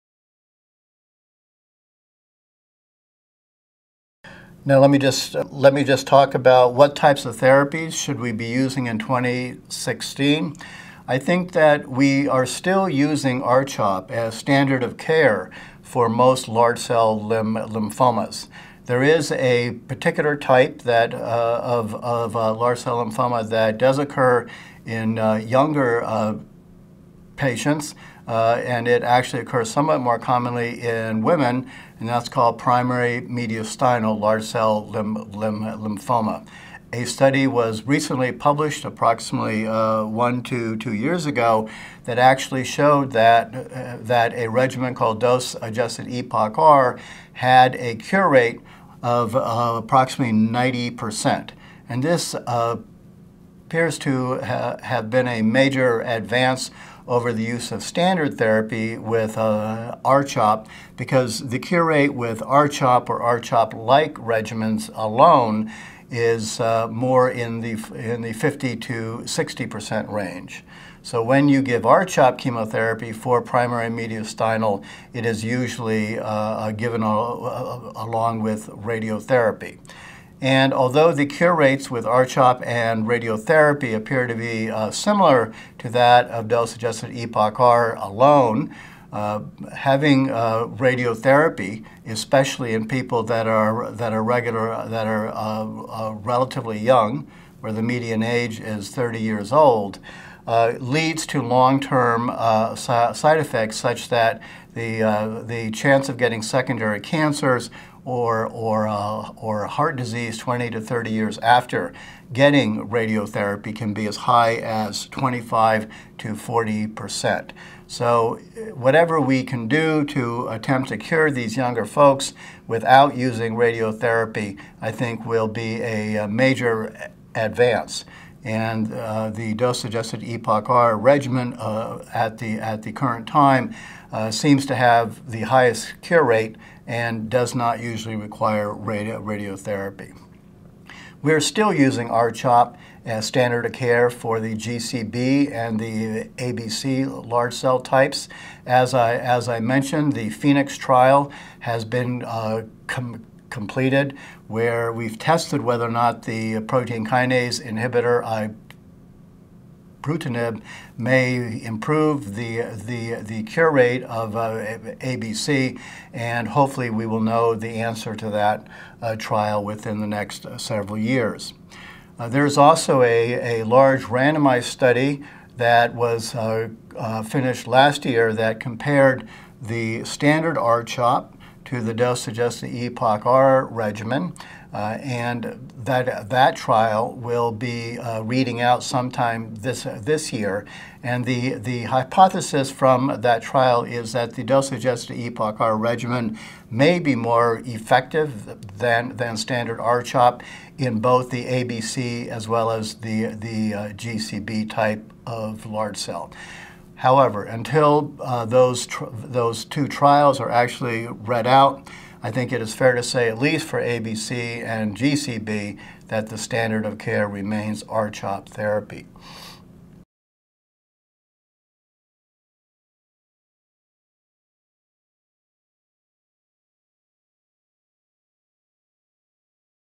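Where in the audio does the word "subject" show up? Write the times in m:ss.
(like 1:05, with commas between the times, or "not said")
not said.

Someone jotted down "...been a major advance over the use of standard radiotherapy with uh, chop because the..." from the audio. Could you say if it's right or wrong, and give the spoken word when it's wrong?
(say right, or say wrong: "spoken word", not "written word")
wrong: "therapy", not "radiotherapy".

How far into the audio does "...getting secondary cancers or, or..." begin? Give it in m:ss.
1:46.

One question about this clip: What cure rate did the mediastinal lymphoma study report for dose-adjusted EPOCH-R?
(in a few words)
90%.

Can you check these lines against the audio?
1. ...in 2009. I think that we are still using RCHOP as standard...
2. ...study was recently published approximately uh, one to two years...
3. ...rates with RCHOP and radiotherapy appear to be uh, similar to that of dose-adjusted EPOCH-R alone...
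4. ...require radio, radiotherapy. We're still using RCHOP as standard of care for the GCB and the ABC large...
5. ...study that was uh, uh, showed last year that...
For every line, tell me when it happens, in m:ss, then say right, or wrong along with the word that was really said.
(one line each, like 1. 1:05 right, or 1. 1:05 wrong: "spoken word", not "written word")
1. 0:08 wrong: "2016", not "2009"
2. 0:37 right
3. 1:21 right
4. 2:18 right
5. 2:54 wrong: "finished", not "showed".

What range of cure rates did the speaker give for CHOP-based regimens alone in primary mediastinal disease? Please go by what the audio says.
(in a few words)
50 to 60 percent.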